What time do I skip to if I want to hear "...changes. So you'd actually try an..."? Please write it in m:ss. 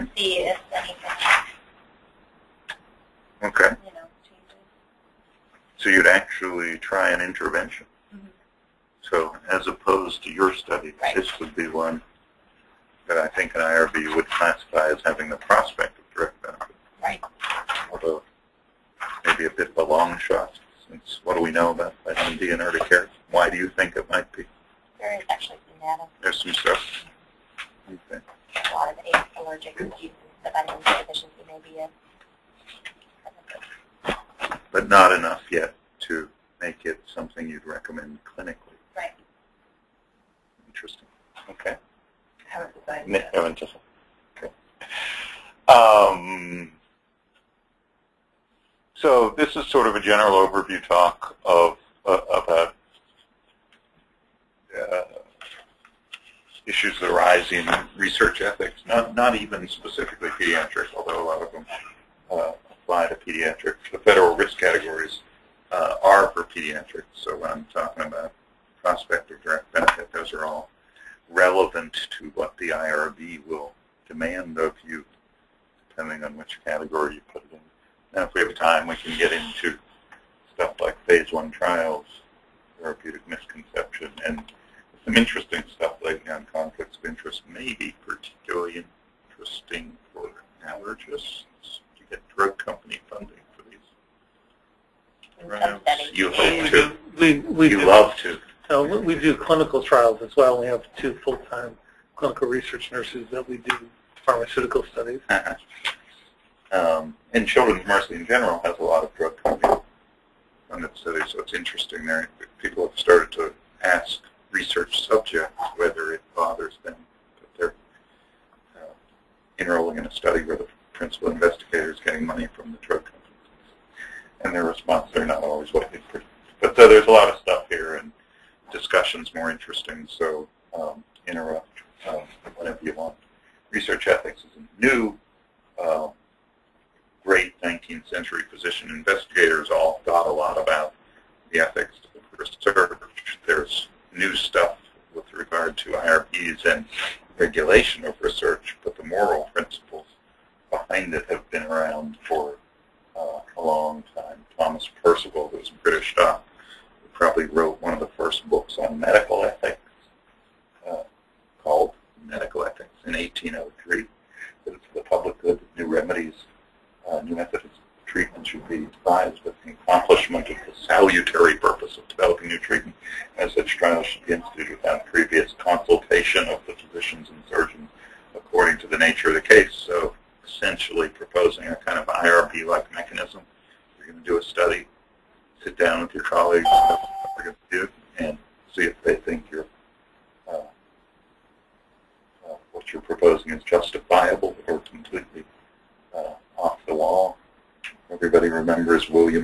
0:04.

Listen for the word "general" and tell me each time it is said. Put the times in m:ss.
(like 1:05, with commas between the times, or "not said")
0:50, 1:48.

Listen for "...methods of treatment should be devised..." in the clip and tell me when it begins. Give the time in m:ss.
2:47.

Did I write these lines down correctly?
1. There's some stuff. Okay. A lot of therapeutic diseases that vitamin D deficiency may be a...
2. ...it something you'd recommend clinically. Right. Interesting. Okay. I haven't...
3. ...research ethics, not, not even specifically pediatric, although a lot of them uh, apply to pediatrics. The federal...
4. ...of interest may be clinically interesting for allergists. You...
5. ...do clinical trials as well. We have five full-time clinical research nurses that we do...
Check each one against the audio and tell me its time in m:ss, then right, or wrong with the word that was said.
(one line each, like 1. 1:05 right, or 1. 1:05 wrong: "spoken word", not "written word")
1. 0:26 wrong: "allergic", not "therapeutic"
2. 0:36 right
3. 0:57 right
4. 1:26 wrong: "particularly", not "clinically"
5. 1:39 wrong: "two", not "five".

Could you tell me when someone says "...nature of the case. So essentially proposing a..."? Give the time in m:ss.
2:58.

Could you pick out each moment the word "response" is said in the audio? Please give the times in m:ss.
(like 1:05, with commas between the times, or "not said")
2:04.